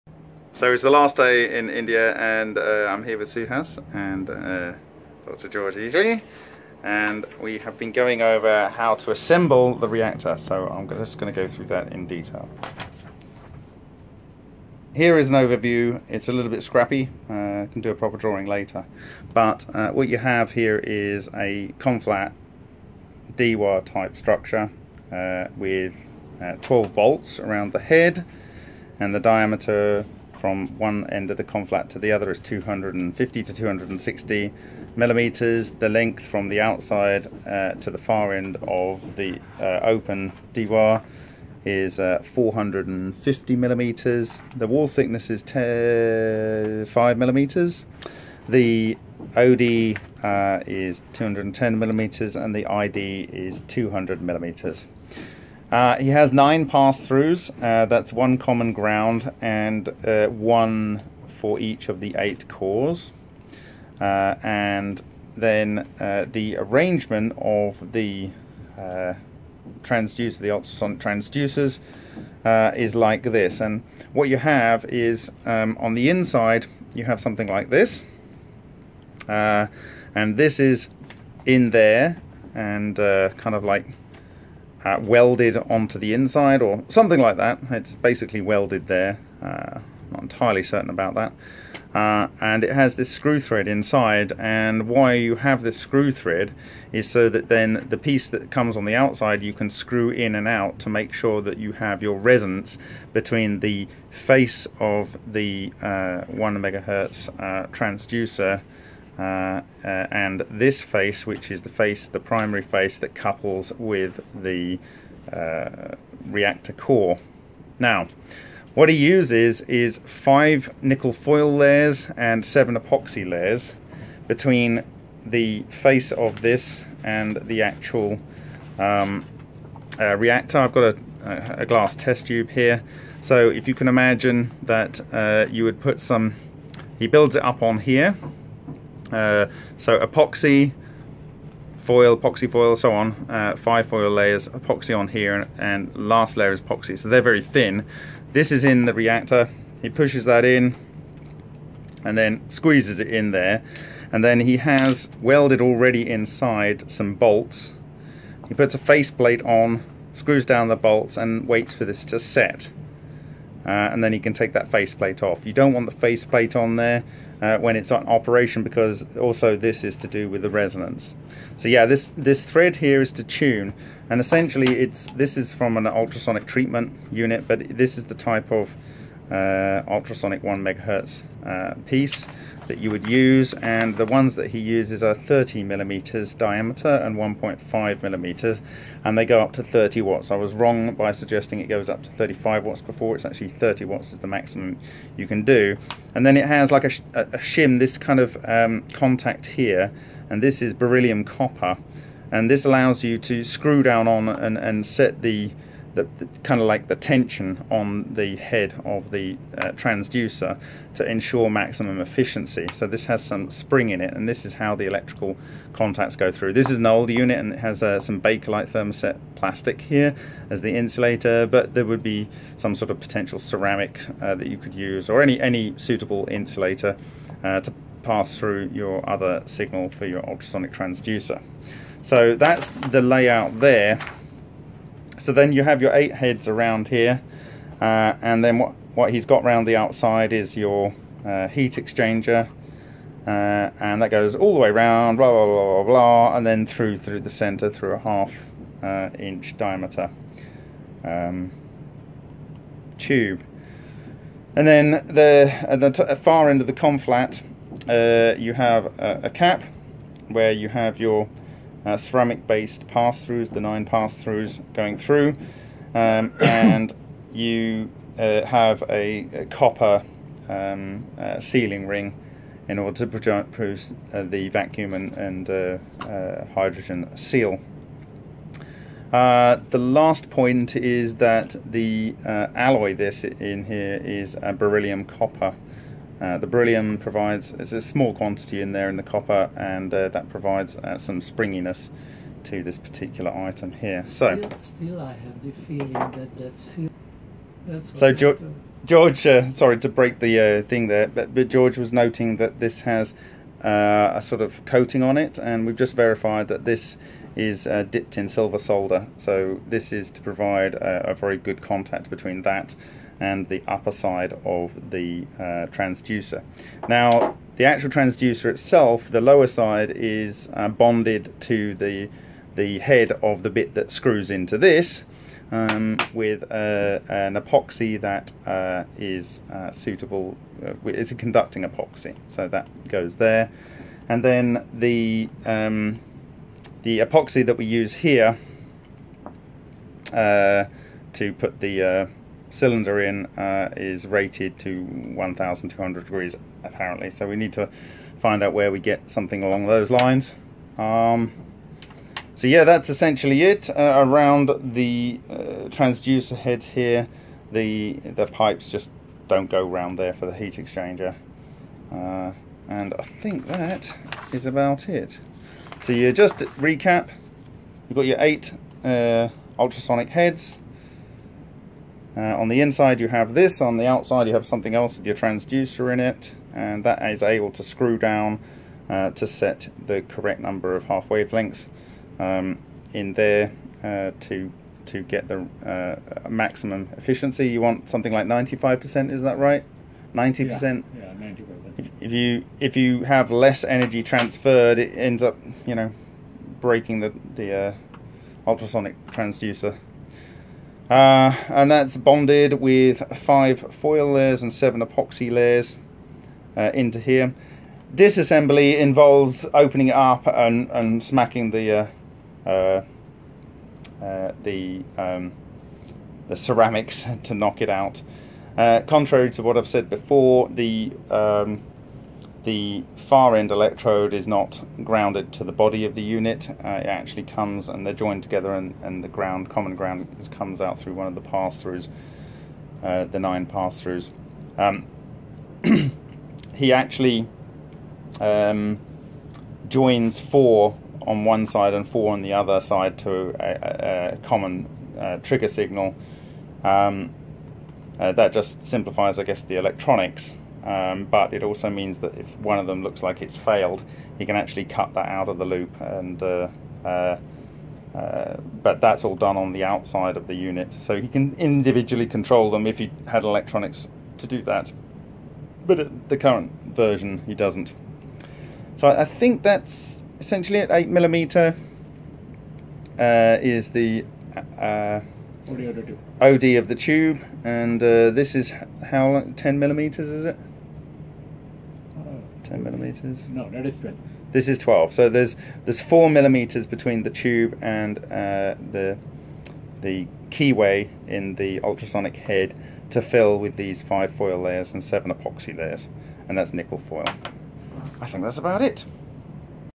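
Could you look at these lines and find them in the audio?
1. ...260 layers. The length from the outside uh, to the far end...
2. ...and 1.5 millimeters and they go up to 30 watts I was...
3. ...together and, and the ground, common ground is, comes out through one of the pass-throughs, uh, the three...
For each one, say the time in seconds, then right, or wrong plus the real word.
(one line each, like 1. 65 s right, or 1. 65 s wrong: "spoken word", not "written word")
1. 33 s wrong: "millimeters", not "layers"
2. 187 s right
3. 428 s wrong: "nine", not "three".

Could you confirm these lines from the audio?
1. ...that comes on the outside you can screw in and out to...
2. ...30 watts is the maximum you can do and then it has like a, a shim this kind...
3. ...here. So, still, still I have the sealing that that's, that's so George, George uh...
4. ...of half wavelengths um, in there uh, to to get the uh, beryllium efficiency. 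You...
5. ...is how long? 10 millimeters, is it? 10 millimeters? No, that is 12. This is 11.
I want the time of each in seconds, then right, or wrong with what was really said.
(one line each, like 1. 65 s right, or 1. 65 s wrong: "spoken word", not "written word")
1. 98 s right
2. 193 s right
3. 293 s wrong: "feeling", not "sealing"
4. 380 s wrong: "maximum", not "beryllium"
5. 478 s wrong: "12", not "11".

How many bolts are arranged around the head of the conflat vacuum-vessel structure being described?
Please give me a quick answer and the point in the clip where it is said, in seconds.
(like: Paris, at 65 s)
12, at 26 s.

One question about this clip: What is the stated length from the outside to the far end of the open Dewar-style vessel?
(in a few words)
450 millimeters.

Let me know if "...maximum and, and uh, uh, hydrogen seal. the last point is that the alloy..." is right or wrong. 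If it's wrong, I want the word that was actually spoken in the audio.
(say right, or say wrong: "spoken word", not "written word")
wrong: "vacuum", not "maximum".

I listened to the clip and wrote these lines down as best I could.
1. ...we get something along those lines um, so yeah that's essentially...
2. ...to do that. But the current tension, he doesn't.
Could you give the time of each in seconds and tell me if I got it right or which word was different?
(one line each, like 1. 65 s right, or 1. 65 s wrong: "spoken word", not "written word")
1. 348 s right
2. 464 s wrong: "version", not "tension".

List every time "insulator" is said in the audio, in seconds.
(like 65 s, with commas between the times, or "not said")
220 s, 226 s.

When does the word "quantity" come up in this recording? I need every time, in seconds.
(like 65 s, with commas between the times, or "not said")
288 s.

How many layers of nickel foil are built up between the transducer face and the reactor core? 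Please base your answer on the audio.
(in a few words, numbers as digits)
5.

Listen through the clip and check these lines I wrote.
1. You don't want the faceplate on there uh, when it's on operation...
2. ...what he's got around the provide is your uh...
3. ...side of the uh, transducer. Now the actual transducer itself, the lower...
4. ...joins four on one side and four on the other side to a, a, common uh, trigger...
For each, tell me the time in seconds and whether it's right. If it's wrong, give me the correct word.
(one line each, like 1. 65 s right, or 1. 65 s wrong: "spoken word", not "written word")
1. 165 s right
2. 238 s wrong: "outside", not "provide"
3. 313 s right
4. 439 s right.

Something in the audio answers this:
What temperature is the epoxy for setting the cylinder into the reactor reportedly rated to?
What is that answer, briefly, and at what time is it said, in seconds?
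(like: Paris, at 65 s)
1200 degrees, at 344 s.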